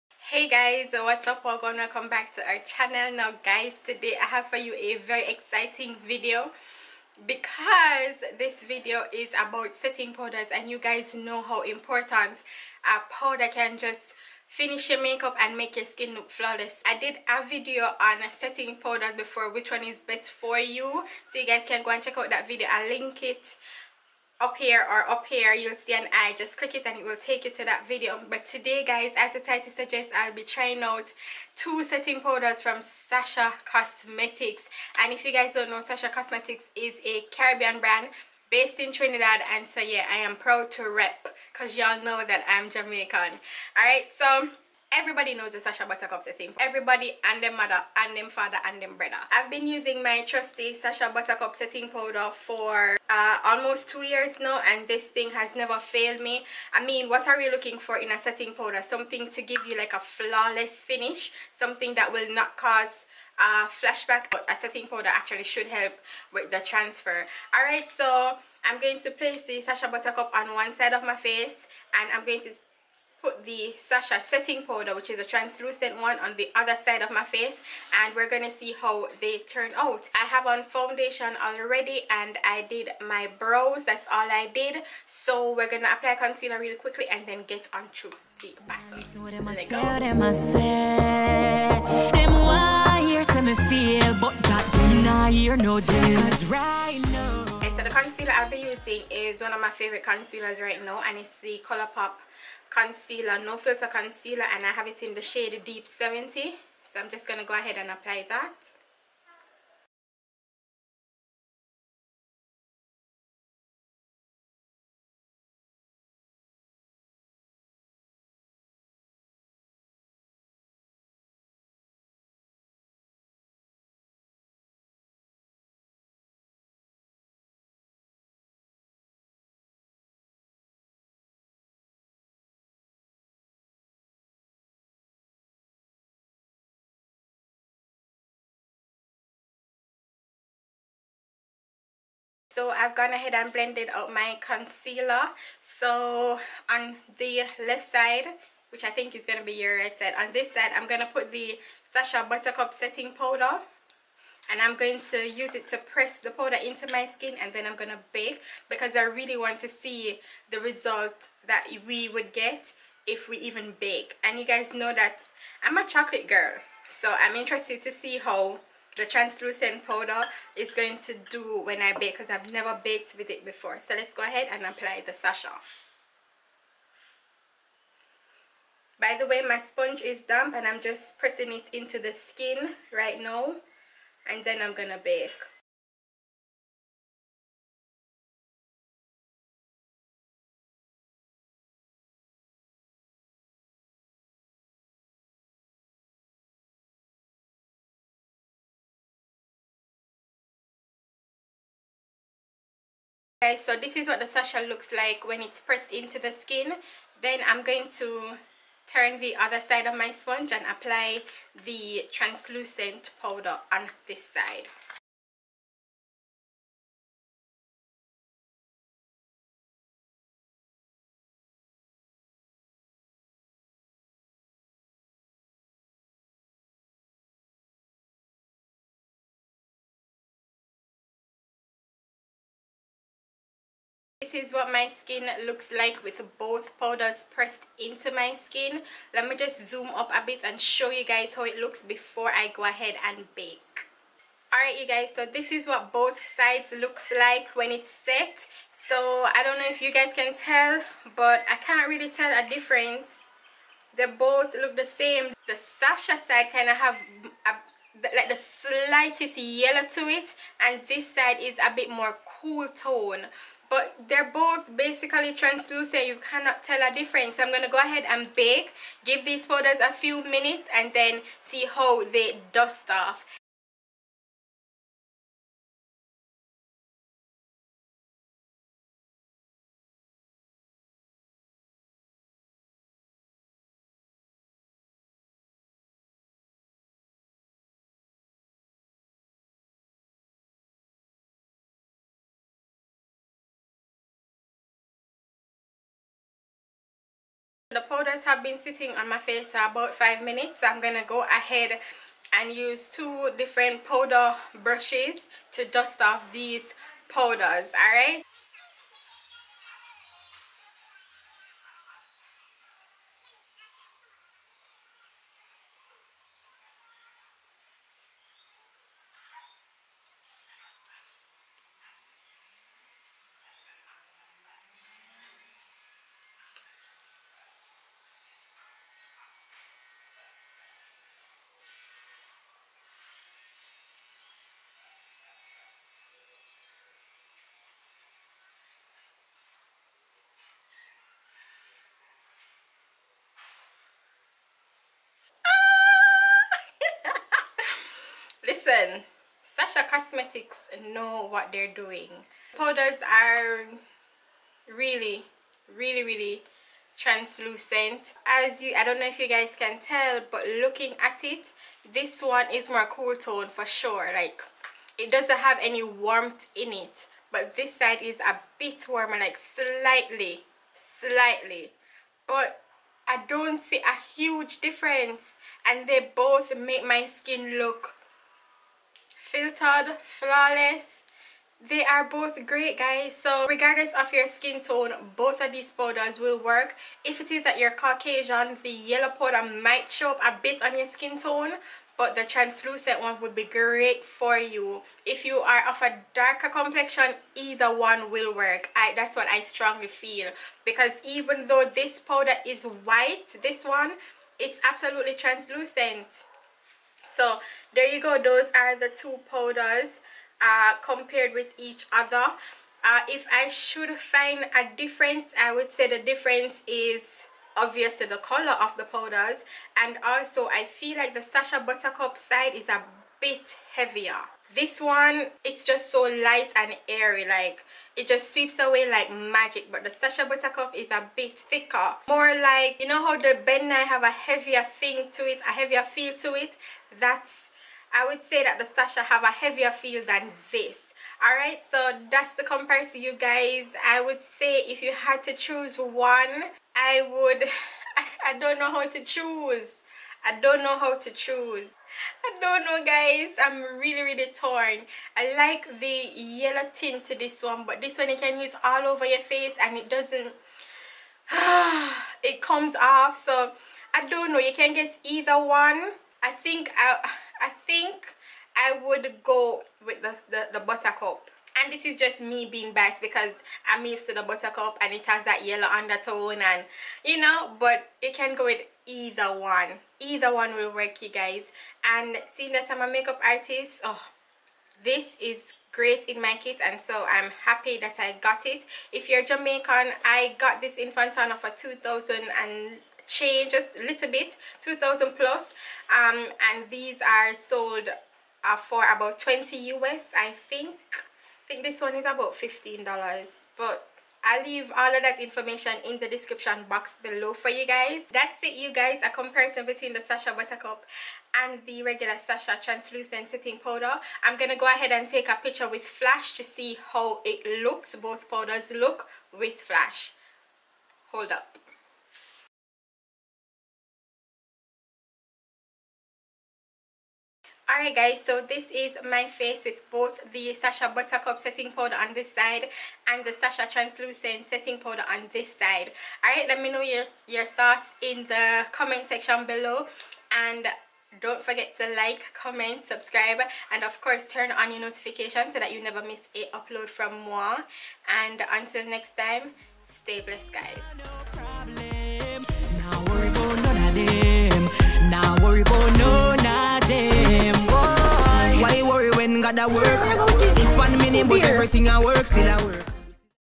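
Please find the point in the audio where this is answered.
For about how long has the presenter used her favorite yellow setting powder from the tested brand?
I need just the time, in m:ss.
0:53.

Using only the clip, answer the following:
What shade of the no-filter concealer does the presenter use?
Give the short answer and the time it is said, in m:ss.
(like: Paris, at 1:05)
deep 70, at 1:45.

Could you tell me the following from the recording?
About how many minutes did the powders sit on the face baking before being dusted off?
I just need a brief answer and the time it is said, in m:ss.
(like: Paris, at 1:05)
5 minutes, at 4:59.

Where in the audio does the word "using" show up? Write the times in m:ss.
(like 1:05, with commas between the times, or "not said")
0:49, 1:38.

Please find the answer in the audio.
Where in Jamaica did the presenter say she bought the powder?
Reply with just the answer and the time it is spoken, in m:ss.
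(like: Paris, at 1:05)
Fontana, at 8:10.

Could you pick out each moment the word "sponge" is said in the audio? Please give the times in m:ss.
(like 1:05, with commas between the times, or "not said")
2:59, 3:30.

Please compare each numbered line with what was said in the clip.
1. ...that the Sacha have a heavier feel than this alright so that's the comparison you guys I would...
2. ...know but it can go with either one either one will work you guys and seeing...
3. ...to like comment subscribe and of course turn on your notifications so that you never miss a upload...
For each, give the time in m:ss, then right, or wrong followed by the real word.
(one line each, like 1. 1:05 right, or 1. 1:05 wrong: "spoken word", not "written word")
1. 7:18 right
2. 7:57 right
3. 9:01 right.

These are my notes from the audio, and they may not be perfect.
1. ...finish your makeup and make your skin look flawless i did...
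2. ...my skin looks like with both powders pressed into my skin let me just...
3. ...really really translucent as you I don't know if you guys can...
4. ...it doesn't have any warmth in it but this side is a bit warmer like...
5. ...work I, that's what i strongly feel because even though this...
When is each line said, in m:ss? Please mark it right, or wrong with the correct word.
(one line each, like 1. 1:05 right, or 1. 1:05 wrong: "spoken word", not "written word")
1. 0:14 right
2. 3:54 right
3. 5:55 right
4. 6:04 right
5. 6:38 right.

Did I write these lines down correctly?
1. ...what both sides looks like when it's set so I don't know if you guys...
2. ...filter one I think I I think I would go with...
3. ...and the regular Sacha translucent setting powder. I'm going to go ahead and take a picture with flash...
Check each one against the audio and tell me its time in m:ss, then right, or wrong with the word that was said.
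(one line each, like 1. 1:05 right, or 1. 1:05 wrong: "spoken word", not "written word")
1. 4:05 right
2. 7:45 wrong: "either", not "filter"
3. 8:31 right.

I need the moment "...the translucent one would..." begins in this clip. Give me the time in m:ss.
6:32.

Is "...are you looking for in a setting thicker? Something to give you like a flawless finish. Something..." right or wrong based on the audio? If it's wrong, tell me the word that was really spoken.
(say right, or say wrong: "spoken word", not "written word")
wrong: "powder", not "thicker".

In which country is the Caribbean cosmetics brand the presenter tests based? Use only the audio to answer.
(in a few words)
Trinidad.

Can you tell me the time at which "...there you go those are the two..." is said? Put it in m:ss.
6:47.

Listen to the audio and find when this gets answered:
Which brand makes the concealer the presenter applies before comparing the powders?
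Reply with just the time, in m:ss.
1:41.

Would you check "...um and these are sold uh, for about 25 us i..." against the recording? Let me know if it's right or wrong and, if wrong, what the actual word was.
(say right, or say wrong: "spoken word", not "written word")
wrong: "20", not "25".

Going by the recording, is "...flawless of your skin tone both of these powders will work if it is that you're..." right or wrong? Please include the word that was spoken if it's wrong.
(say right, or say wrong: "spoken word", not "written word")
wrong: "regardless", not "flawless".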